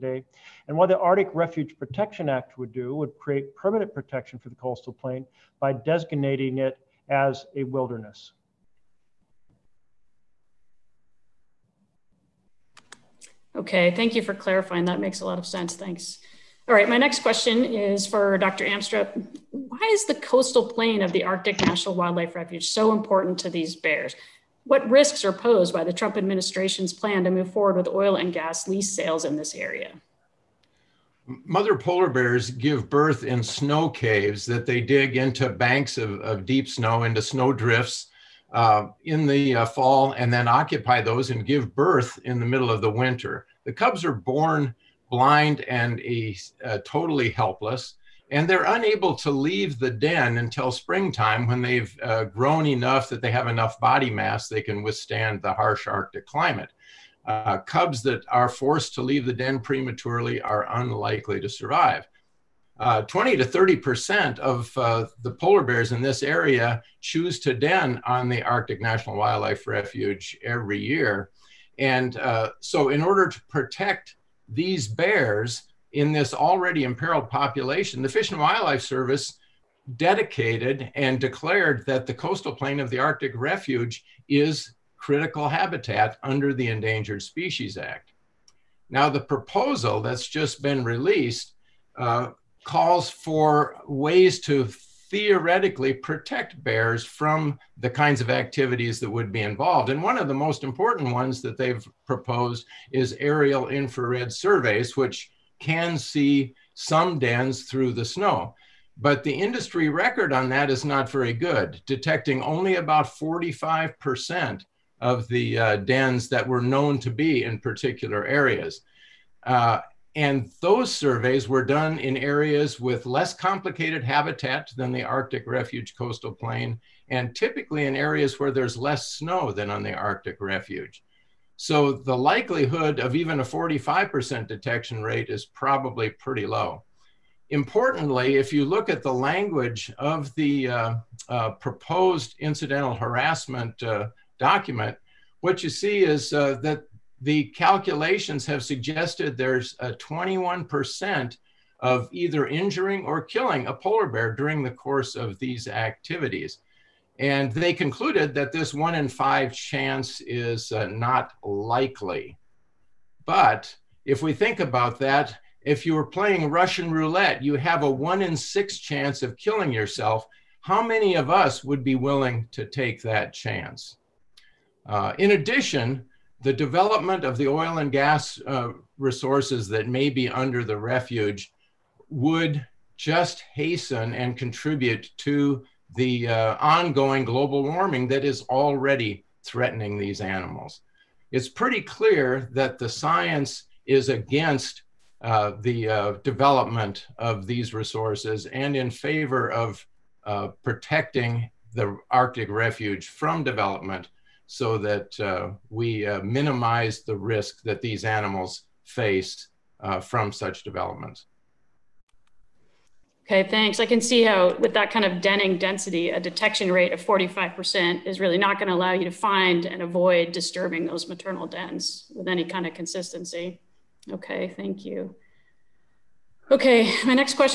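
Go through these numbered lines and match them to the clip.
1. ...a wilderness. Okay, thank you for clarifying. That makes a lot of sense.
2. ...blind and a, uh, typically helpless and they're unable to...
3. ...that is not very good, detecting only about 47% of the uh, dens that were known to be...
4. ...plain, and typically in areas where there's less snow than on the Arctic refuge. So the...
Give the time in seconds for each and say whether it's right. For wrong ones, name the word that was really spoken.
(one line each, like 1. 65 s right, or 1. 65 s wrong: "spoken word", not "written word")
1. 7 s right
2. 45 s wrong: "totally", not "typically"
3. 110 s wrong: "45", not "47"
4. 126 s right.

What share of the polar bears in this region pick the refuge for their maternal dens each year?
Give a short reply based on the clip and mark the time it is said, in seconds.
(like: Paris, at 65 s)
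20 to 30 percent, at 63 s.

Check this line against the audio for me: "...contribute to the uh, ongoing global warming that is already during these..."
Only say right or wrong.
wrong.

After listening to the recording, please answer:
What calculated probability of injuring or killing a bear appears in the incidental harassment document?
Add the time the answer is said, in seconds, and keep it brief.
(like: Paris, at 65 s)
21%, at 149 s.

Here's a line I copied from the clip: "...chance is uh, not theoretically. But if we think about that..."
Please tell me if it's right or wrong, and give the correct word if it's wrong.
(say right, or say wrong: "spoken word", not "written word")
wrong: "likely", not "theoretically".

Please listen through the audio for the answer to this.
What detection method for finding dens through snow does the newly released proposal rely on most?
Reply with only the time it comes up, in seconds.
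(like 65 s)
103 s.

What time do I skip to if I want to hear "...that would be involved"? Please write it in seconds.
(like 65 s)
98 s.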